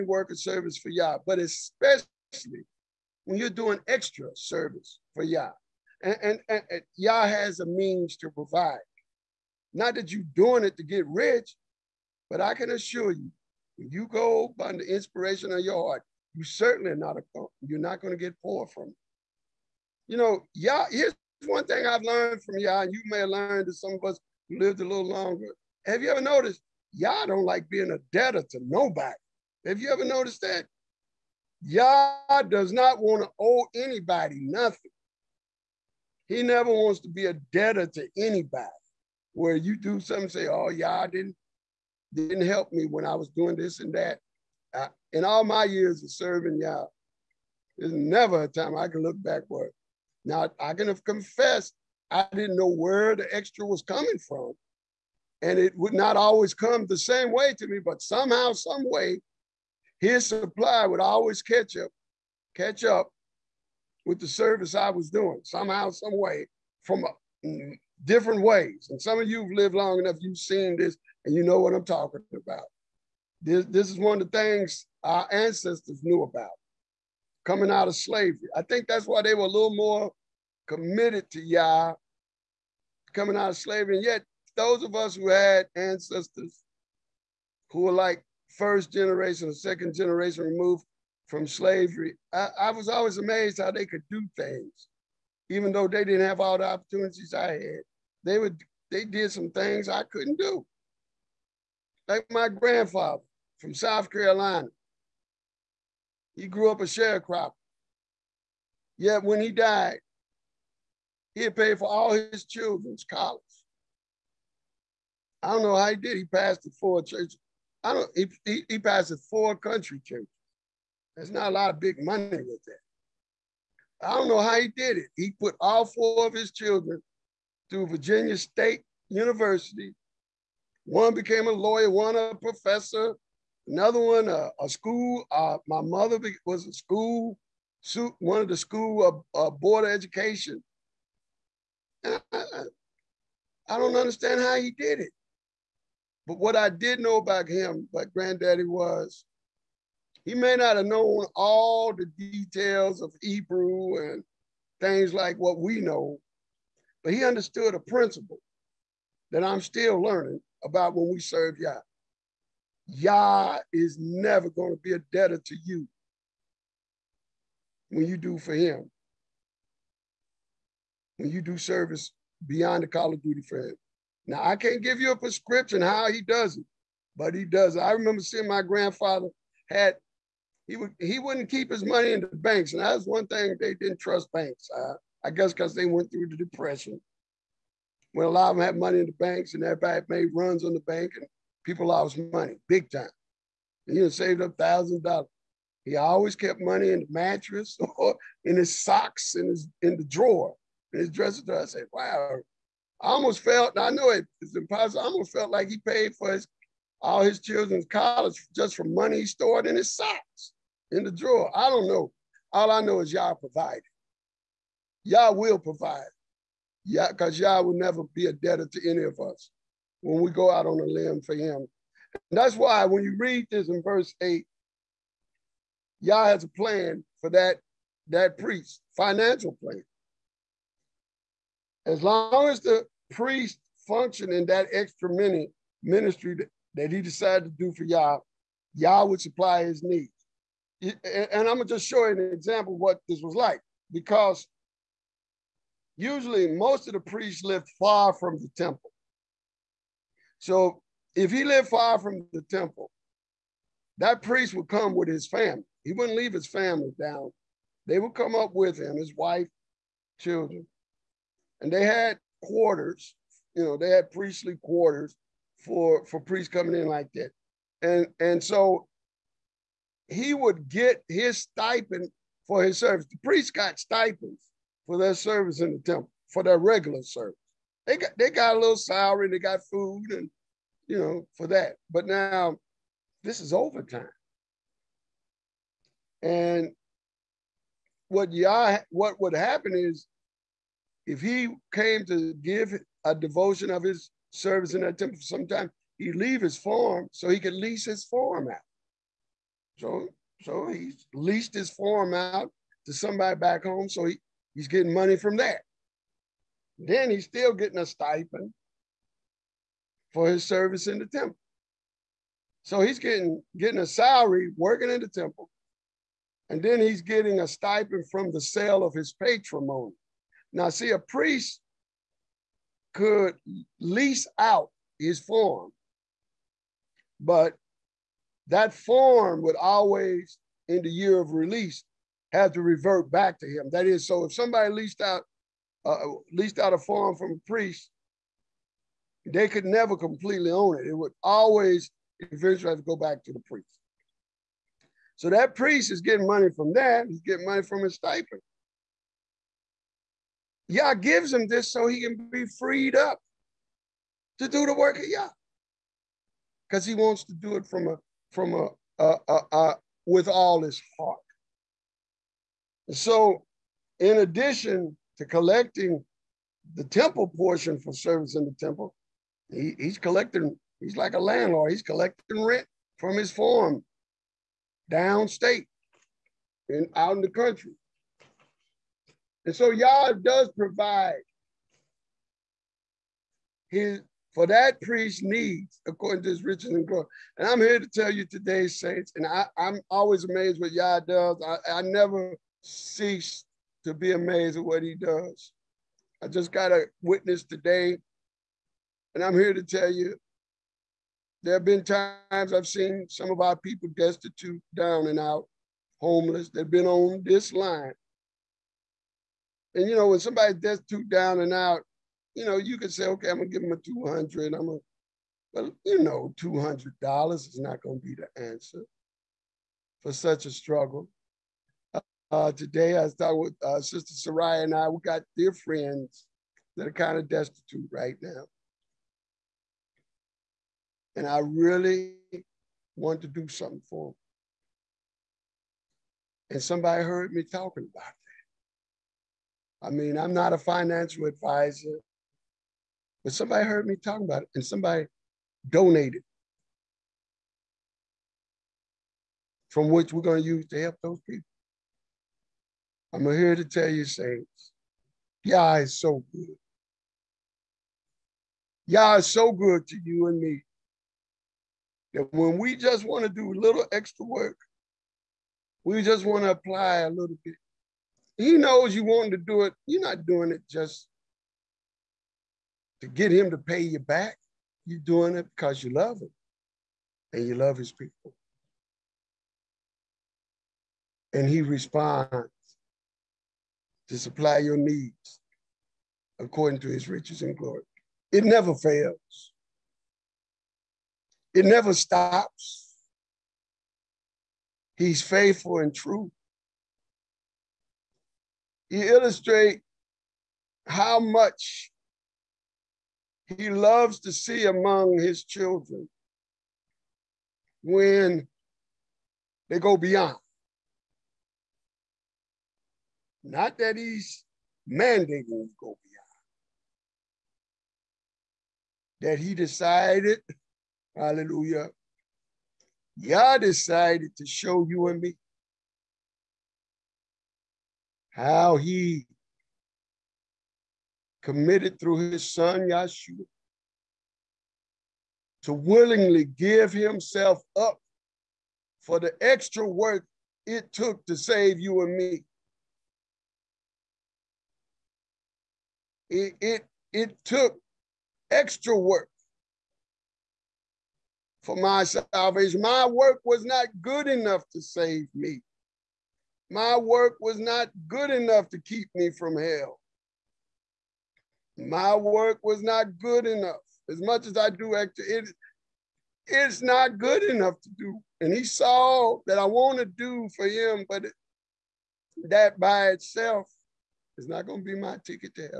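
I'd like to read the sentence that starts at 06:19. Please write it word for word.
And so Yah does provide his for that priest needs, according to his riches and glory.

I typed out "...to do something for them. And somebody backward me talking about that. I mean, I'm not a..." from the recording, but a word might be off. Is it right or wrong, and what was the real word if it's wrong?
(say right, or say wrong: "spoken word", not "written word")
wrong: "heard", not "backward".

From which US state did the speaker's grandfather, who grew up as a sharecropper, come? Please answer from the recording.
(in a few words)
South Carolina.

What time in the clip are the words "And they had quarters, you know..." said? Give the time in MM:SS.
04:21.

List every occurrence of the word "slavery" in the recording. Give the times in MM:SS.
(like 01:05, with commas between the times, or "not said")
01:17, 01:23, 01:31.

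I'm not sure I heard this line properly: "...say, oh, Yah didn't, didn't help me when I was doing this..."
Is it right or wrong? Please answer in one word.
right.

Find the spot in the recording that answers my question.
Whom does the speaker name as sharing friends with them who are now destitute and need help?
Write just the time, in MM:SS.
07:03.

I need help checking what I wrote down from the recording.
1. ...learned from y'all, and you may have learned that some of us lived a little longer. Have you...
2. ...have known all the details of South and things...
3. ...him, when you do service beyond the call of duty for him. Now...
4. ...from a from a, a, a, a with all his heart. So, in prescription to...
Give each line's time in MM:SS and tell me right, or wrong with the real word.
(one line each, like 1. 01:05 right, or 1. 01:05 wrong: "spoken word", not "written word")
1. 00:22 right
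2. 02:30 wrong: "Hebrew", not "South"
3. 02:48 right
4. 05:57 wrong: "addition", not "prescription".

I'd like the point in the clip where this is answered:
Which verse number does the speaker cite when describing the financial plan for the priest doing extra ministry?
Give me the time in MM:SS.
03:43.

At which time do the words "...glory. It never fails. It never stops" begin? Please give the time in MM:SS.
08:07.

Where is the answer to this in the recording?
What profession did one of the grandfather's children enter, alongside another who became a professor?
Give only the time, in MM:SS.
02:11.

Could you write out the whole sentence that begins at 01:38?
They would they did some things I couldn't do.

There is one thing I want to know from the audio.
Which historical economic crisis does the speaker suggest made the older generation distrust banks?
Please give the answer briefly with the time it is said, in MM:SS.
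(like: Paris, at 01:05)
the Depression, at 03:06.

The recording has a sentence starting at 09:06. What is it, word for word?
It, it, it took extra work for my salvation.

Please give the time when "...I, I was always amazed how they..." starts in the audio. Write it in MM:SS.
01:32.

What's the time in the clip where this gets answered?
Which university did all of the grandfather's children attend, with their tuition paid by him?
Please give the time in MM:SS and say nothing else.
02:07.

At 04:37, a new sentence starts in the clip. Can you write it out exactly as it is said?
They got they got a little salary, they got food, and you know, for that.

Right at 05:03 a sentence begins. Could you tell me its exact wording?
So he, he's getting money from that.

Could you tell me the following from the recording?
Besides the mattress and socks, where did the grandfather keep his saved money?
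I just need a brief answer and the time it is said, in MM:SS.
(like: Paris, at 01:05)
dresser drawer, at 03:21.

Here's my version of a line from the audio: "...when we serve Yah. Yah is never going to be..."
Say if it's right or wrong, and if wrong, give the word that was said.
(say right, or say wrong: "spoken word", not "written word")
right.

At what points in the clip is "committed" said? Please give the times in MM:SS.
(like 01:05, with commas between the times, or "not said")
01:20, 08:51.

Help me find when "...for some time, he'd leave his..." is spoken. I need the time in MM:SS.
04:55.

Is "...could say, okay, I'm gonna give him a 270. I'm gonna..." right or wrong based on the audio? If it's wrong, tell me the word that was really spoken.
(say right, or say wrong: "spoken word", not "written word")
wrong: "200", not "270".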